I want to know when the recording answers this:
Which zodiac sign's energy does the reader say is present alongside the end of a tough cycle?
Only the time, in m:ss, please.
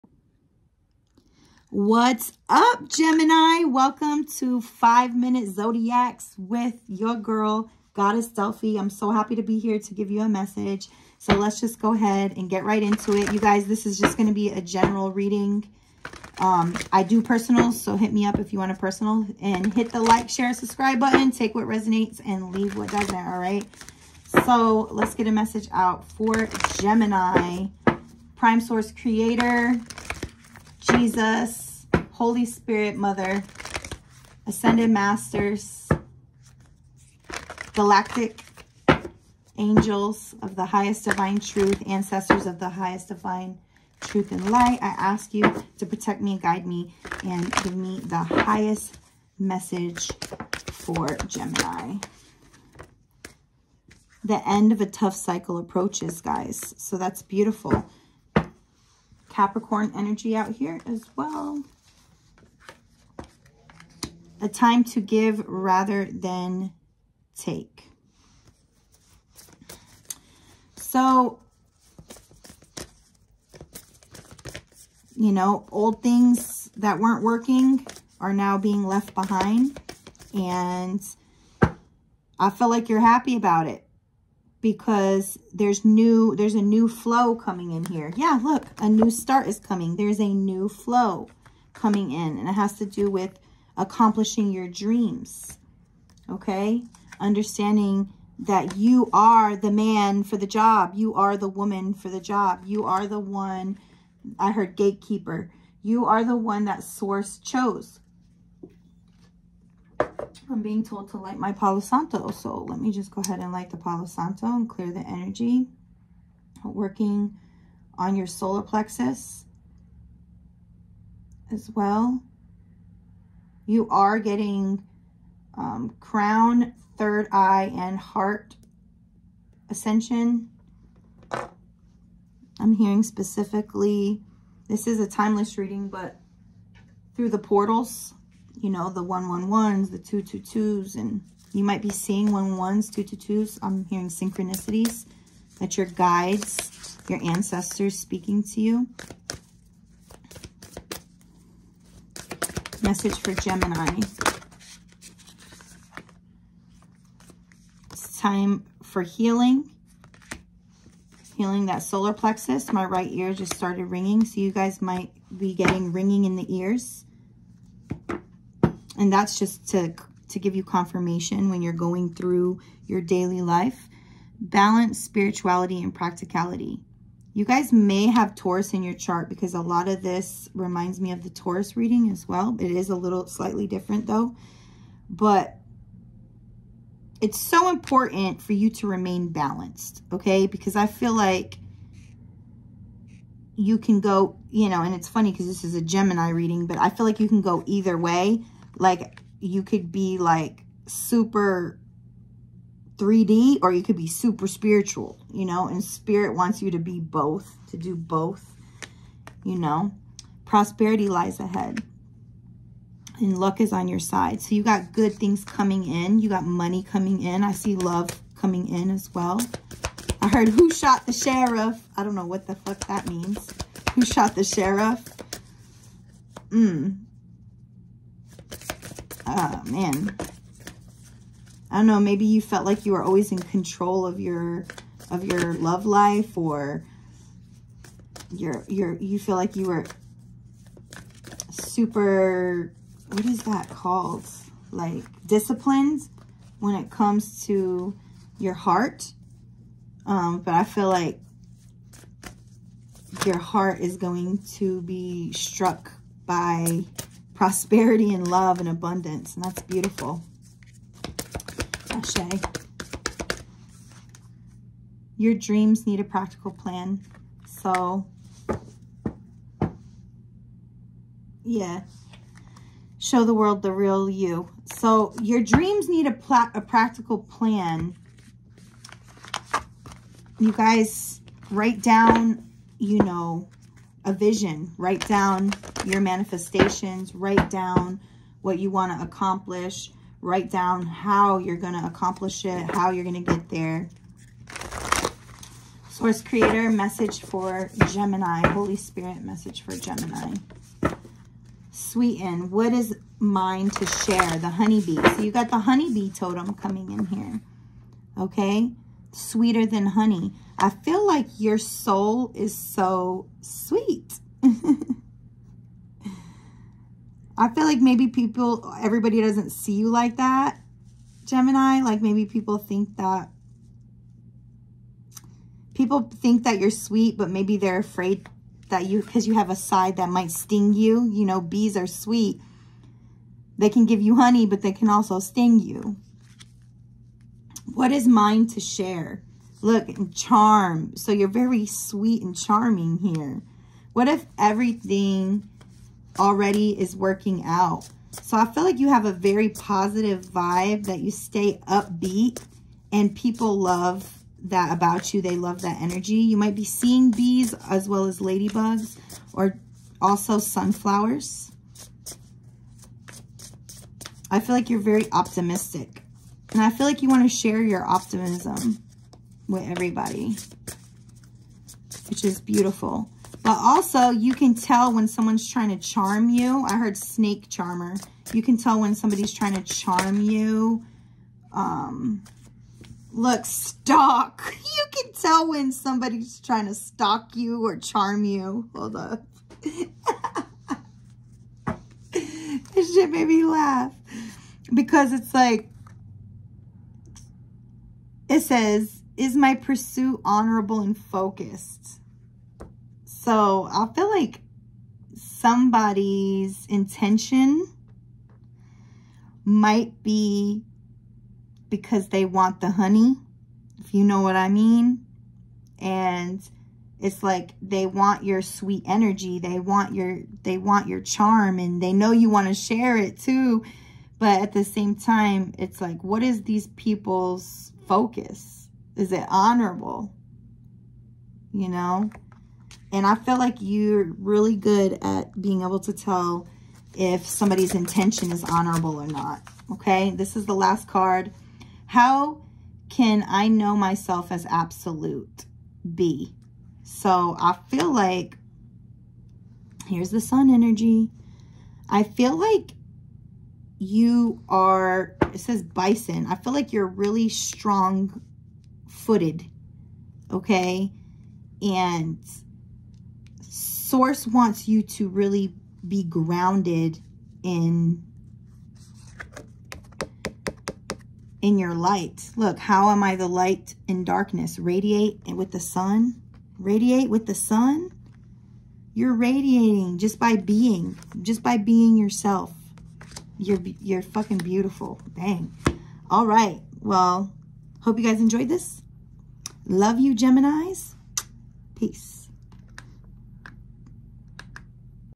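0:59.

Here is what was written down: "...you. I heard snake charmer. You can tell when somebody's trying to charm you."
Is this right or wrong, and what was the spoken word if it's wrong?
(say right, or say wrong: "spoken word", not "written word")
right.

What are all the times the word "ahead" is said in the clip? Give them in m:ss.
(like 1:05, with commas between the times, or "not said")
0:11, 1:53, 3:31.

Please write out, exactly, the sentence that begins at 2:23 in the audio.
I'm hearing synchronicities that your guides, your ancestors speaking to you.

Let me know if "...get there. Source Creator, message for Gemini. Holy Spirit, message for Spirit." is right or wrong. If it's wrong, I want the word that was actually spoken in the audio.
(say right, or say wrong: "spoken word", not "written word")
wrong: "Gemini", not "Spirit".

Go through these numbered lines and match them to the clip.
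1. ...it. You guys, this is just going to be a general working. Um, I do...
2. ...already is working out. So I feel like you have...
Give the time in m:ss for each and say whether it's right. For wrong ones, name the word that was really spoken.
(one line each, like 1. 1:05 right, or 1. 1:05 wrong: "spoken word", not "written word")
1. 0:13 wrong: "reading", not "working"
2. 5:46 right.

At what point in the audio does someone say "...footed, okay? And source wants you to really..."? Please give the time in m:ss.
7:38.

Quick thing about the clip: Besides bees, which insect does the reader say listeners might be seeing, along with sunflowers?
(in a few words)
Ladybugs.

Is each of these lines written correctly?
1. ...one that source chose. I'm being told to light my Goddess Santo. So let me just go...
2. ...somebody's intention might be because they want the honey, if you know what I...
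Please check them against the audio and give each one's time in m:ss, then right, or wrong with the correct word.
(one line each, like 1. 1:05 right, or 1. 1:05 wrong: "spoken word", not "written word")
1. 1:46 wrong: "Palo", not "Goddess"
2. 6:45 right.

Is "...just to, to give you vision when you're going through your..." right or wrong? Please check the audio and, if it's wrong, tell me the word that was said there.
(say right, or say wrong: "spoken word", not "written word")
wrong: "confirmation", not "vision".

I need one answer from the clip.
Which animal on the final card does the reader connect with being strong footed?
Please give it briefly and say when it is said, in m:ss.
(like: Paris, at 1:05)
Bison, at 7:35.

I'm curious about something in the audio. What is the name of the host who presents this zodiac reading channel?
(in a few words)
Goddess Delphi.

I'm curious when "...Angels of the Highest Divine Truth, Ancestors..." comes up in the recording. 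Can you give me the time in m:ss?
0:39.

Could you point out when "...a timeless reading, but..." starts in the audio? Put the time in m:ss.
2:14.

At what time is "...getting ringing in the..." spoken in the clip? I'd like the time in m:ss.
2:45.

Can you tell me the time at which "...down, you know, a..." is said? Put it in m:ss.
4:41.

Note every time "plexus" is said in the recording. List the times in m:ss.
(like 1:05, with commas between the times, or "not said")
1:58, 2:42.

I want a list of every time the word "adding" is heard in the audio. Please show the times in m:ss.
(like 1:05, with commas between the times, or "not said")
not said.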